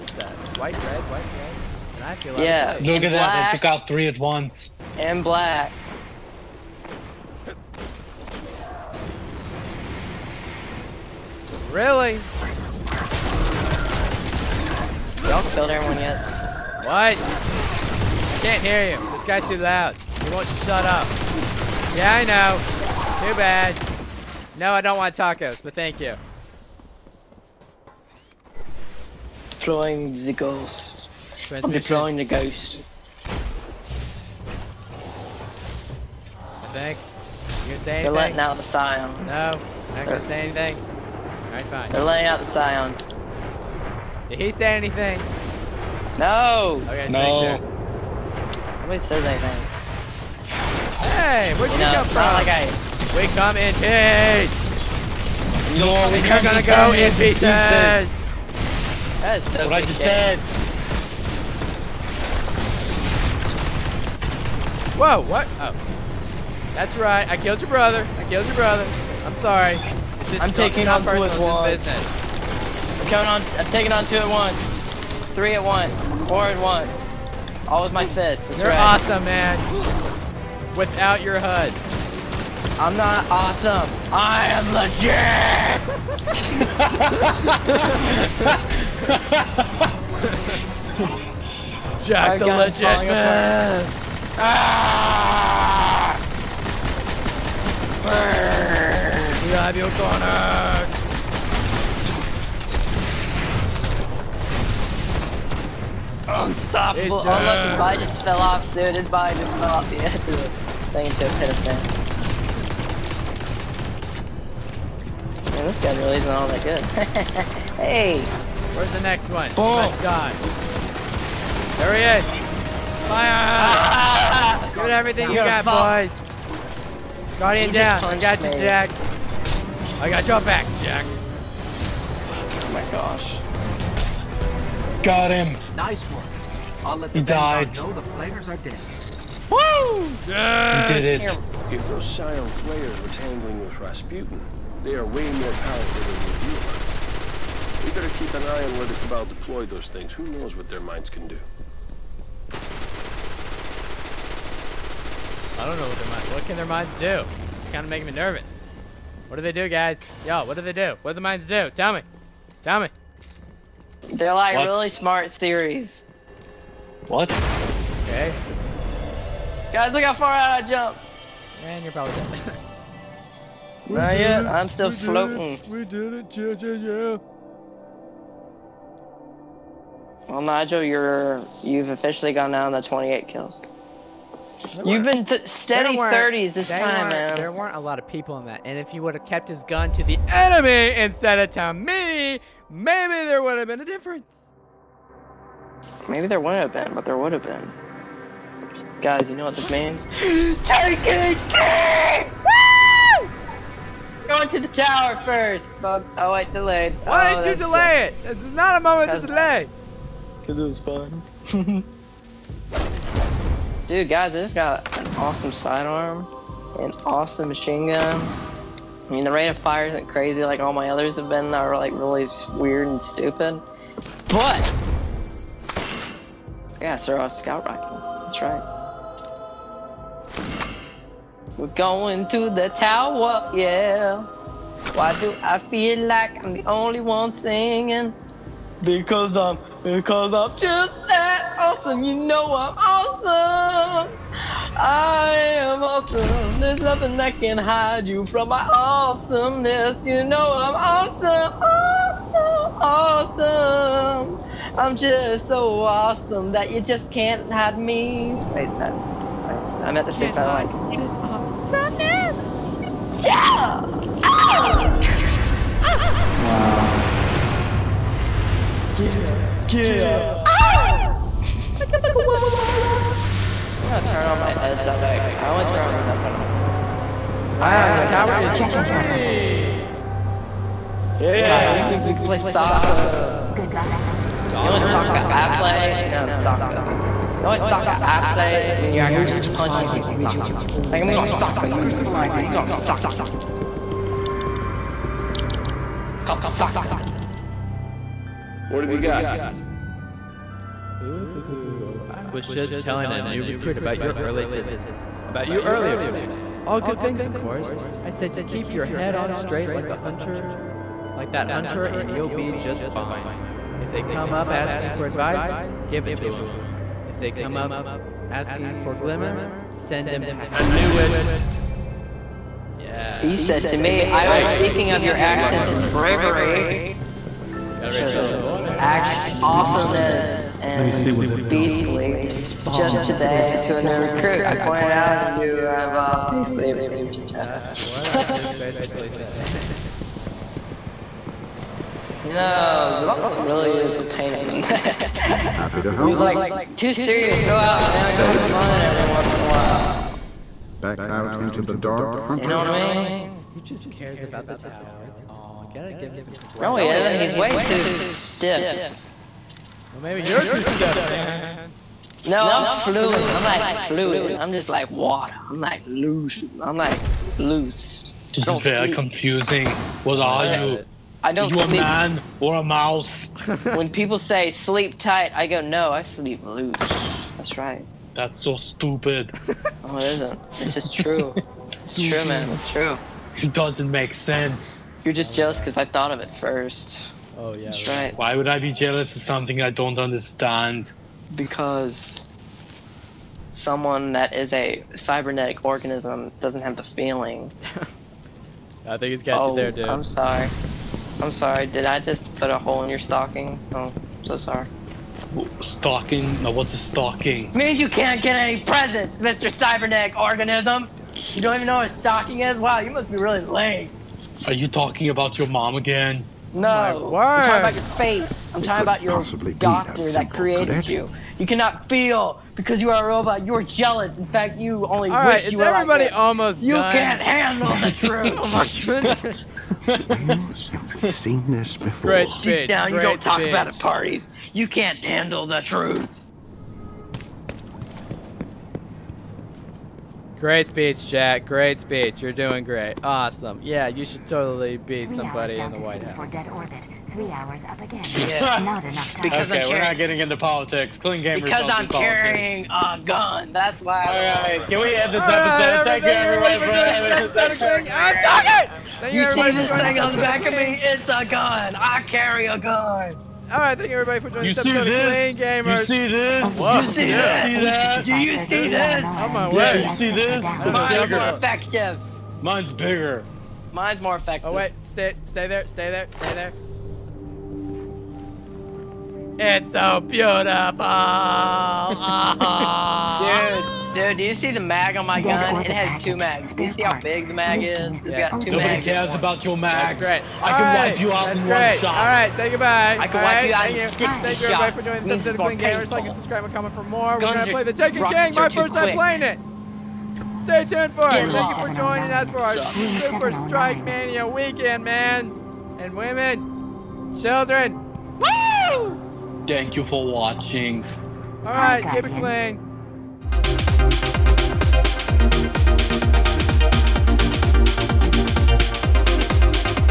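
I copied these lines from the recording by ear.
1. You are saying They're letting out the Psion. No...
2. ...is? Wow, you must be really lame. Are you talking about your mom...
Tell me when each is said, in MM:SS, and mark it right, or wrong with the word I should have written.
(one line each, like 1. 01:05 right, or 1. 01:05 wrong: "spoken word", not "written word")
1. 00:37 right
2. 06:52 right.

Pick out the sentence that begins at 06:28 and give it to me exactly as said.
Why would I be jealous of something I don't understand?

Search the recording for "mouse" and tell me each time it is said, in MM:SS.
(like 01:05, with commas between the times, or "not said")
06:12.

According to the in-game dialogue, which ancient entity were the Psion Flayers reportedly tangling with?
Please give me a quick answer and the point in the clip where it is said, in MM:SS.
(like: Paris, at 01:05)
Rasputin, at 02:23.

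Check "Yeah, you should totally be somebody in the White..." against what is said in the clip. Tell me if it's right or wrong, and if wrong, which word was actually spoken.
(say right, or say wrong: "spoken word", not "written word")
right.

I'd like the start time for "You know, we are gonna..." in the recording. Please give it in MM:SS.
00:55.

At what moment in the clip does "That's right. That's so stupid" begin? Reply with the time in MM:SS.
06:17.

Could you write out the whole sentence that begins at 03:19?
Guys, you know what this means?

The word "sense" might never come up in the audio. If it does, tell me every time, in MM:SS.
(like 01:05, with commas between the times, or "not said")
06:24.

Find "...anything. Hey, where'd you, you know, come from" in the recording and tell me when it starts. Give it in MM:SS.
00:49.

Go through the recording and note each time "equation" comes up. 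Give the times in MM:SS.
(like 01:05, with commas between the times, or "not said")
not said.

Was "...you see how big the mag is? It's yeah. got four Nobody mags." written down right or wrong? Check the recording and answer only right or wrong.
wrong.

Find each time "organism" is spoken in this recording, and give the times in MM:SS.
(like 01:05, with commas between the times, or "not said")
06:35, 06:50.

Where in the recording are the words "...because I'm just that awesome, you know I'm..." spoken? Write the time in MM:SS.
03:59.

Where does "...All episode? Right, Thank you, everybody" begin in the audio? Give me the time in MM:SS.
07:35.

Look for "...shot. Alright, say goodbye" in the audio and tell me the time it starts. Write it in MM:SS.
08:11.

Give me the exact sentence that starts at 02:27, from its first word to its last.
We better keep an eye on where the Cabal deploy those things.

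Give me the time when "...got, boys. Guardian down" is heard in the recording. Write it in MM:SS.
02:05.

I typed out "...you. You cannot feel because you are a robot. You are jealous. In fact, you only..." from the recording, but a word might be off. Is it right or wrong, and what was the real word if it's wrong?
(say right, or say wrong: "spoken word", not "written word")
right.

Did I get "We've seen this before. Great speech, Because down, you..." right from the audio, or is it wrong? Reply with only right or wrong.
wrong.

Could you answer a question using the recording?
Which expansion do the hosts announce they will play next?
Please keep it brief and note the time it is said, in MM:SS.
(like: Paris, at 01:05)
The Taken King, at 08:17.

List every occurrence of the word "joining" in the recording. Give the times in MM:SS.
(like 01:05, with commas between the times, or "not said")
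07:44, 08:14, 08:21.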